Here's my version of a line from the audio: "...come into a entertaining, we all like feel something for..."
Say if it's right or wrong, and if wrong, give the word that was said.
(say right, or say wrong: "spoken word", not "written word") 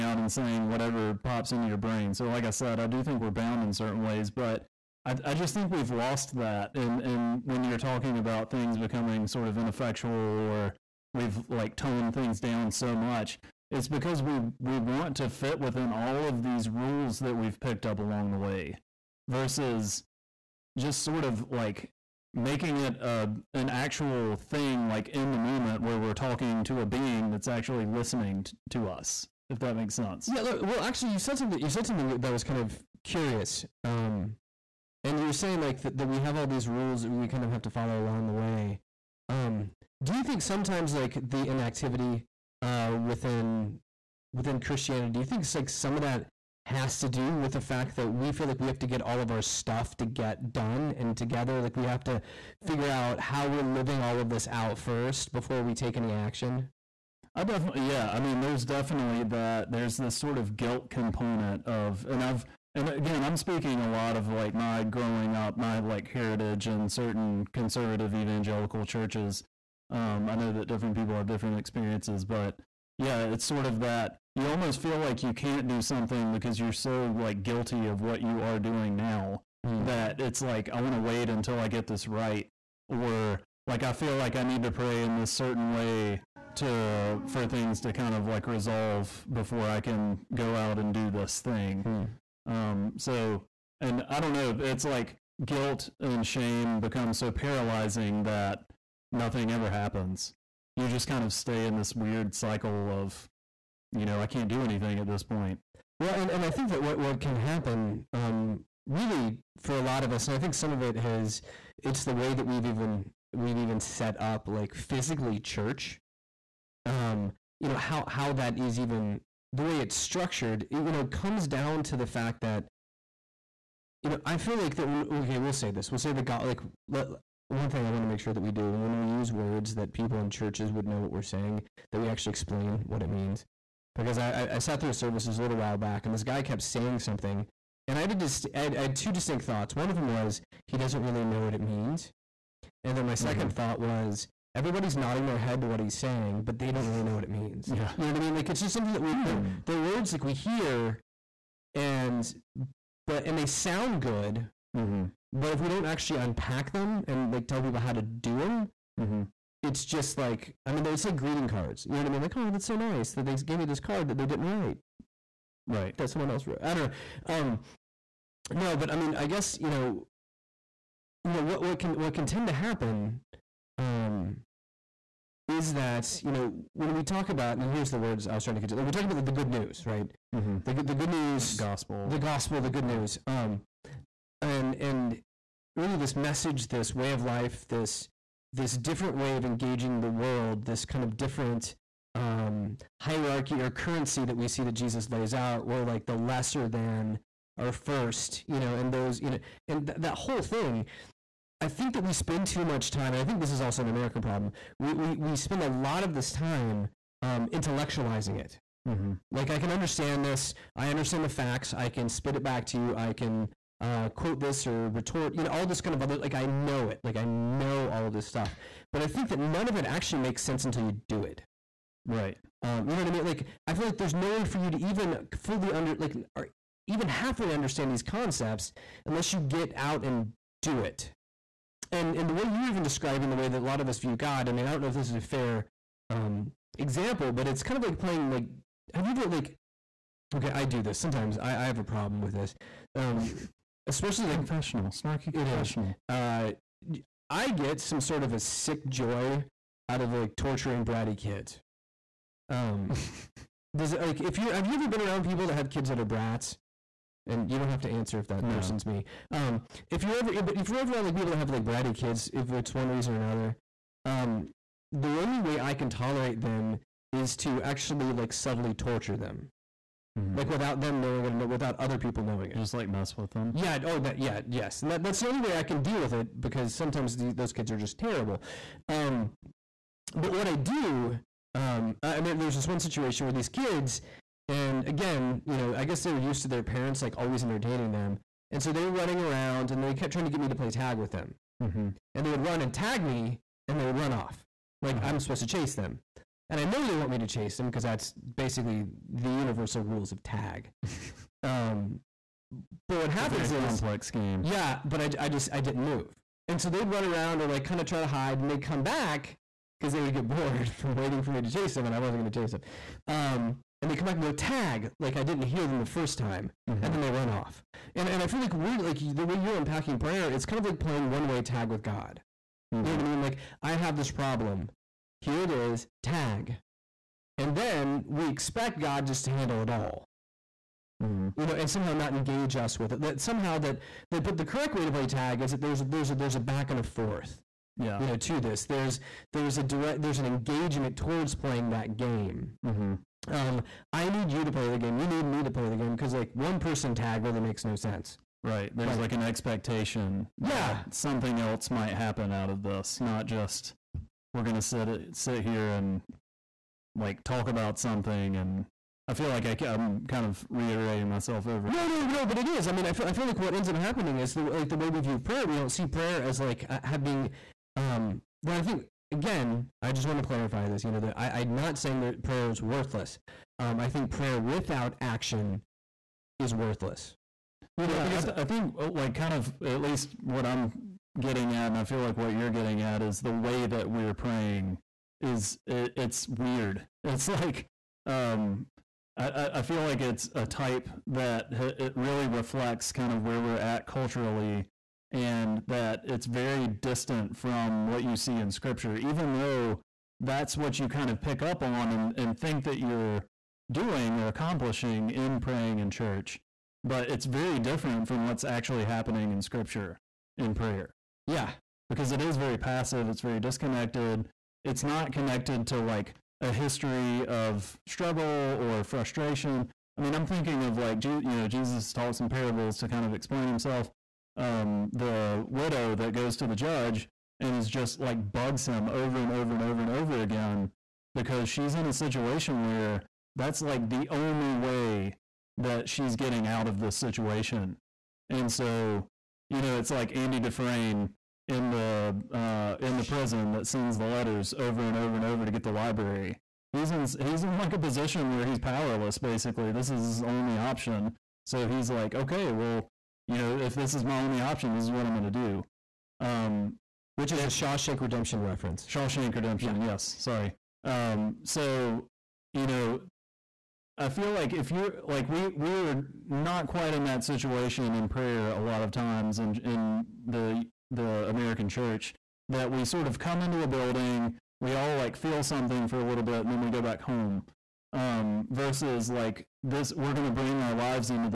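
wrong: "building", not "entertaining".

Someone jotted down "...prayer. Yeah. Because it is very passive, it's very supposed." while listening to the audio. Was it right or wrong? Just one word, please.
wrong.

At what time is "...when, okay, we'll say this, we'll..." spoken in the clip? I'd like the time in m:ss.
2:04.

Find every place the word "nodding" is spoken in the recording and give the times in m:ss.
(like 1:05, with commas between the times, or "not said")
2:24.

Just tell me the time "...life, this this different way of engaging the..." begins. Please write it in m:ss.
3:07.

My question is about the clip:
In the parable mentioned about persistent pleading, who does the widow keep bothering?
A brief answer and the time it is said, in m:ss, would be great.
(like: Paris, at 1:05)
the judge, at 7:06.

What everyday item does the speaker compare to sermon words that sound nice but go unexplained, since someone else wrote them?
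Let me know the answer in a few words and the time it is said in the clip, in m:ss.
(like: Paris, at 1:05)
greeting cards, at 2:41.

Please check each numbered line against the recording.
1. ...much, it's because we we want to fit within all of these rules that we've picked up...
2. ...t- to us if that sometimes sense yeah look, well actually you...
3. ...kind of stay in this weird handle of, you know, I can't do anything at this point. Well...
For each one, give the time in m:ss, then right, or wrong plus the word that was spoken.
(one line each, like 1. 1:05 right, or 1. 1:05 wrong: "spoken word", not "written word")
1. 0:12 right
2. 0:28 wrong: "makes", not "sometimes"
3. 1:41 wrong: "cycle", not "handle".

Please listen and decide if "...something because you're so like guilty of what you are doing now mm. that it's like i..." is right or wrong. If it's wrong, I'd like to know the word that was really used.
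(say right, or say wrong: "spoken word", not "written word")
right.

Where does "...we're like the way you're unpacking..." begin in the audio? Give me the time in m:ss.
5:18.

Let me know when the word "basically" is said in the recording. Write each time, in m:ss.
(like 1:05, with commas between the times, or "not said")
4:58, 7:29.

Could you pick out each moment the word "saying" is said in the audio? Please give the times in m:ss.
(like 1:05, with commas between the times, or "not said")
0:00, 0:35, 2:11, 2:16, 2:25, 6:11.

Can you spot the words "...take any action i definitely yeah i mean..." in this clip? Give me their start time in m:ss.
0:55.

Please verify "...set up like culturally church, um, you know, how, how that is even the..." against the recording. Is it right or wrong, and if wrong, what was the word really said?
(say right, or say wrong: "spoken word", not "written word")
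wrong: "physically", not "culturally".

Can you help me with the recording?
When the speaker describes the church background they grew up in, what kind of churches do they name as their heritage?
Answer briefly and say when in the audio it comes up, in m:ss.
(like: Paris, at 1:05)
conservative evangelical, at 1:07.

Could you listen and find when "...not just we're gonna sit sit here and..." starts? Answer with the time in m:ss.
5:52.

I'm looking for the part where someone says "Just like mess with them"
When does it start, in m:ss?
4:32.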